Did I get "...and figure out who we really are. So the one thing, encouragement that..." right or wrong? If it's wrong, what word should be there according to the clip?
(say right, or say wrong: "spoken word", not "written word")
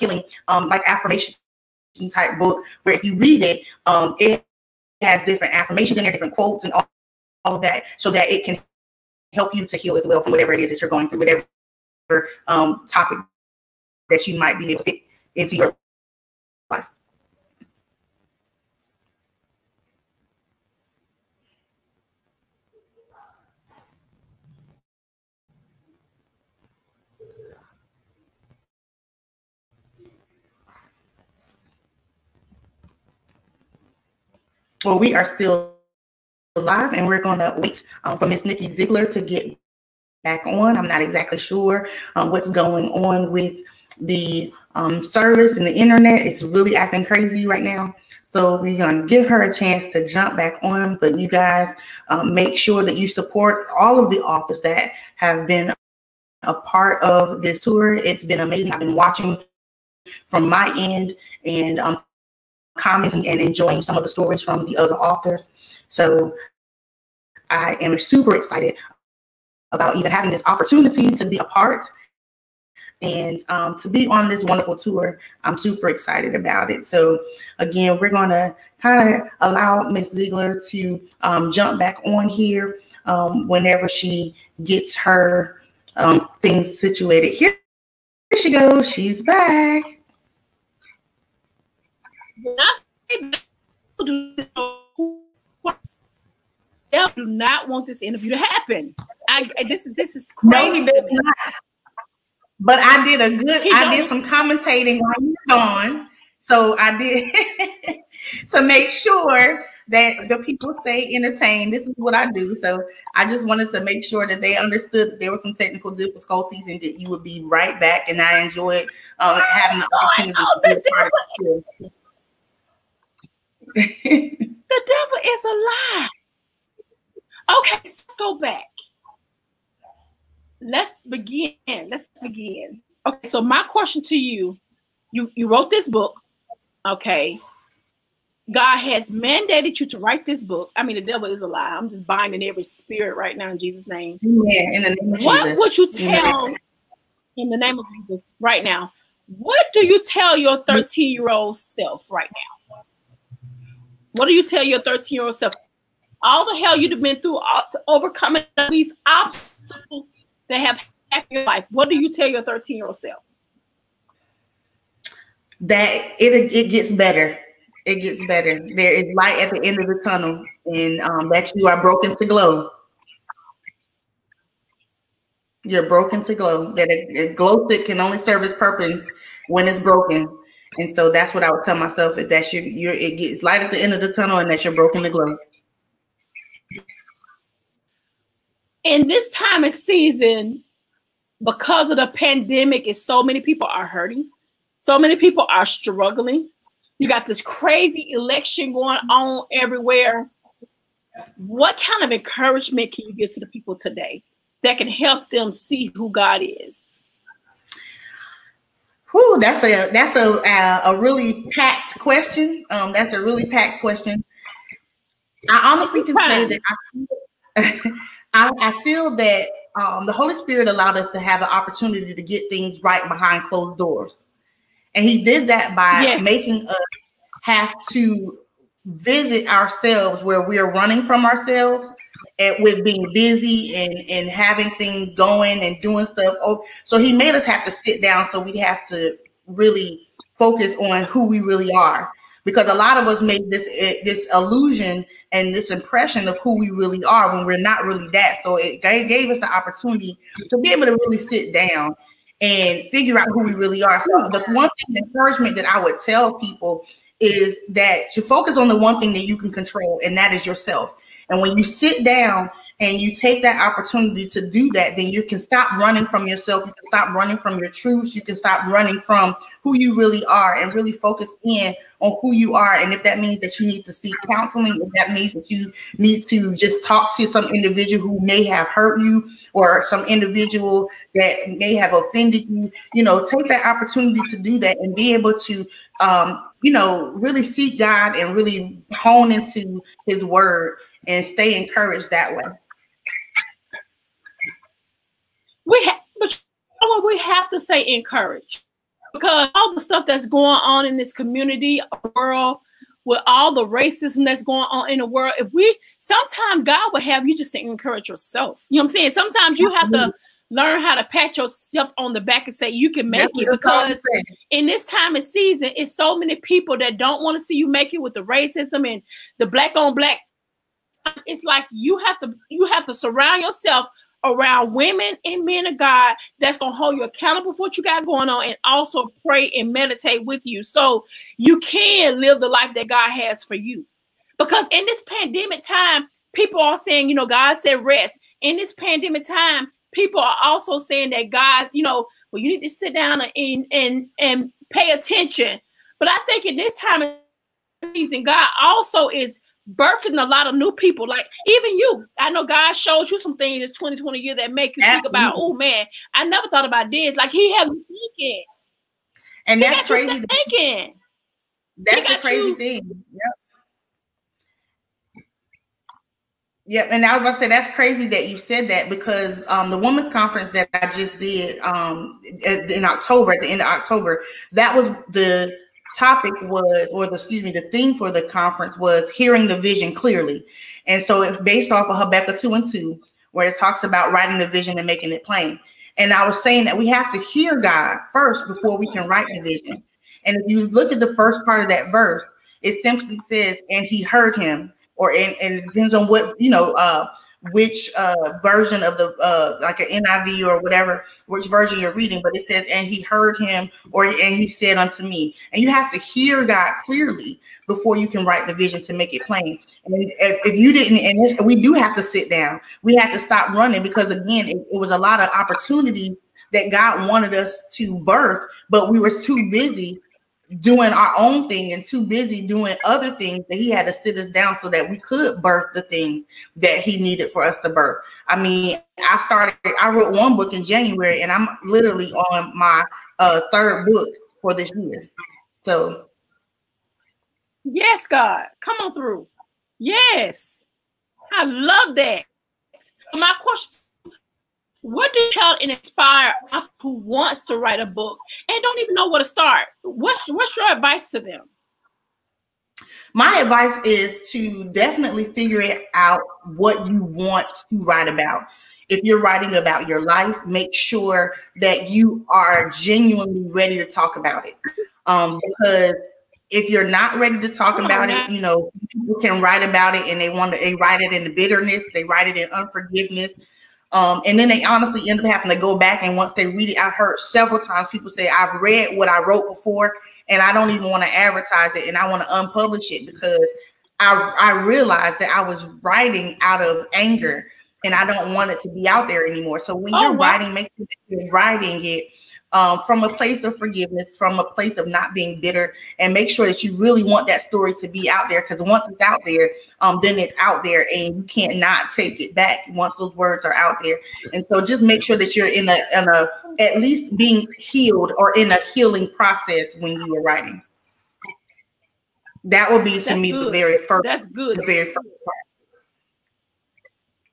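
right.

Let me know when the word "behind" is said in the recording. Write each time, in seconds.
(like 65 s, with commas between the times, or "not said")
223 s.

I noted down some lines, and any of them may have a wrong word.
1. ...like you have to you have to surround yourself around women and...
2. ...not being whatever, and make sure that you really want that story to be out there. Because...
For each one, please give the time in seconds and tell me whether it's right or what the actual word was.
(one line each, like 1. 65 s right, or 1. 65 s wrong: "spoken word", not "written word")
1. 321 s right
2. 494 s wrong: "bitter", not "whatever".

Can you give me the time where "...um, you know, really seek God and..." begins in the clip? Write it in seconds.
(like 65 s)
286 s.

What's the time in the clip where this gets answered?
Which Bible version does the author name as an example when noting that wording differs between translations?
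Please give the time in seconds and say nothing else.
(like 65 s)
400 s.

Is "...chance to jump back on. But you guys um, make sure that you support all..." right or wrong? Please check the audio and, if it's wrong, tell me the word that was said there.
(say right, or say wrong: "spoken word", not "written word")
right.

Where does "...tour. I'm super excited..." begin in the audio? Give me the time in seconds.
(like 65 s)
74 s.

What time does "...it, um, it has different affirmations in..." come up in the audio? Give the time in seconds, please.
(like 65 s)
3 s.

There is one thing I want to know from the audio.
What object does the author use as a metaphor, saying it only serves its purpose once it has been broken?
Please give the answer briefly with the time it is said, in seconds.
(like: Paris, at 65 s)
glow stick, at 177 s.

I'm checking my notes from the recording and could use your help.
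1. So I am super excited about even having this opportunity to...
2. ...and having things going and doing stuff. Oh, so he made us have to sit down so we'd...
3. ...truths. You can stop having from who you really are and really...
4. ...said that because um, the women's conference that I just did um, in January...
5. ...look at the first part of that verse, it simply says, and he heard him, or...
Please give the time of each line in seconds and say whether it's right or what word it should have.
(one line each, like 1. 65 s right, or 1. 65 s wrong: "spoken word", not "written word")
1. 65 s right
2. 234 s right
3. 267 s wrong: "running", not "having"
4. 368 s wrong: "October", not "January"
5. 390 s right.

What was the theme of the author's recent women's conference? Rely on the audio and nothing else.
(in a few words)
hearing the vision clearly.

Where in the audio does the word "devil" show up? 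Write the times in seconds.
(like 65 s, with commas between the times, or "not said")
124 s, 141 s.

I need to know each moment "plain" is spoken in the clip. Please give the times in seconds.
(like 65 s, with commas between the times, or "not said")
385 s, 409 s.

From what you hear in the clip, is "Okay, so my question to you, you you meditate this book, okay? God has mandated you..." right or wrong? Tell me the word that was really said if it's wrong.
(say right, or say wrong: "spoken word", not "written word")
wrong: "wrote", not "meditate".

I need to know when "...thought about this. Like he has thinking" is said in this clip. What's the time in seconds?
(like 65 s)
356 s.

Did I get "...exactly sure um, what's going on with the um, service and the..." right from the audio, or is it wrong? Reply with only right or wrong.
right.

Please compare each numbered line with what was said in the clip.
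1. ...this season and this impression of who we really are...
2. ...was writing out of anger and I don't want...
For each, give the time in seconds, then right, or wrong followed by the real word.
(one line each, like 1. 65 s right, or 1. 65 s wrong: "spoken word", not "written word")
1. 244 s wrong: "illusion", not "season"
2. 485 s right.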